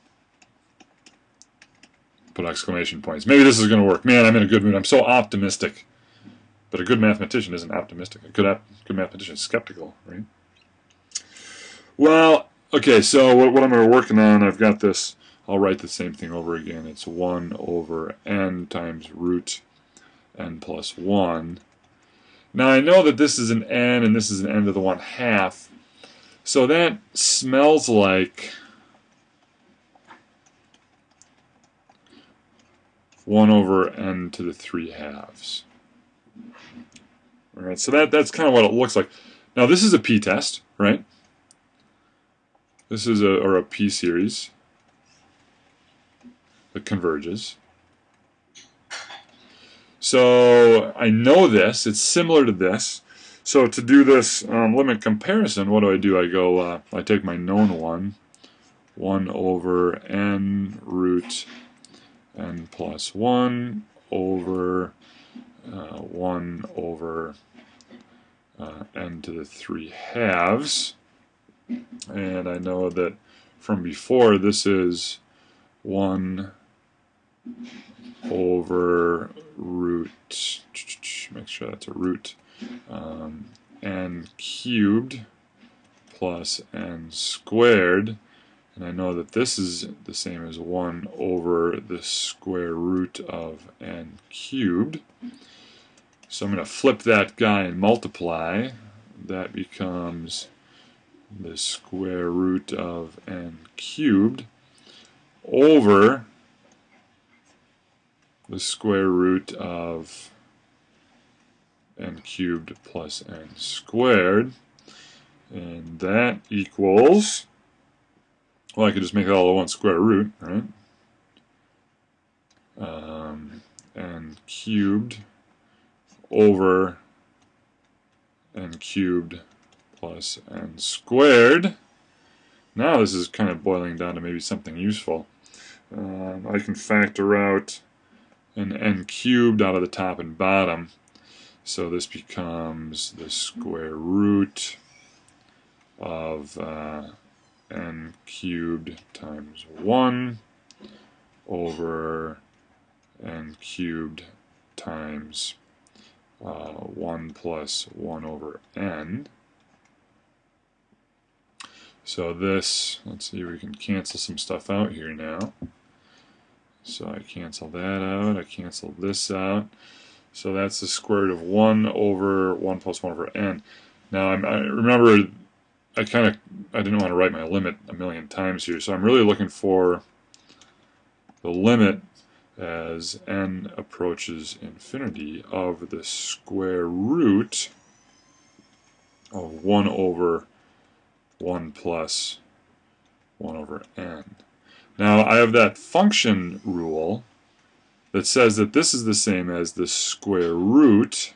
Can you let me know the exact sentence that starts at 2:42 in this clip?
So this, let's see, we can cancel some stuff out here now.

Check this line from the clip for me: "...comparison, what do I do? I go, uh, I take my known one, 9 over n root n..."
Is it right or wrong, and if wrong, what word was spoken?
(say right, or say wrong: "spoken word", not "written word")
wrong: "1", not "9".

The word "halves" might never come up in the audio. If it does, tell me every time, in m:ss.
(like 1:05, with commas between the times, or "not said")
0:34, 1:09.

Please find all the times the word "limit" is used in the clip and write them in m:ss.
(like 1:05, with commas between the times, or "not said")
0:54, 2:57, 3:01.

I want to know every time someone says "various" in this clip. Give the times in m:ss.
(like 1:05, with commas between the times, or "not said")
not said.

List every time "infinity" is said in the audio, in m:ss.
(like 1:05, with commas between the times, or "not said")
3:04.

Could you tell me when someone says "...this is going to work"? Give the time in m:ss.
0:03.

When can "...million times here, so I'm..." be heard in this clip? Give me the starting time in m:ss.
2:57.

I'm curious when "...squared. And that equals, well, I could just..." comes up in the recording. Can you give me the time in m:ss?
1:53.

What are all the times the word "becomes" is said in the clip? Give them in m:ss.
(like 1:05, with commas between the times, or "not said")
1:39, 2:22.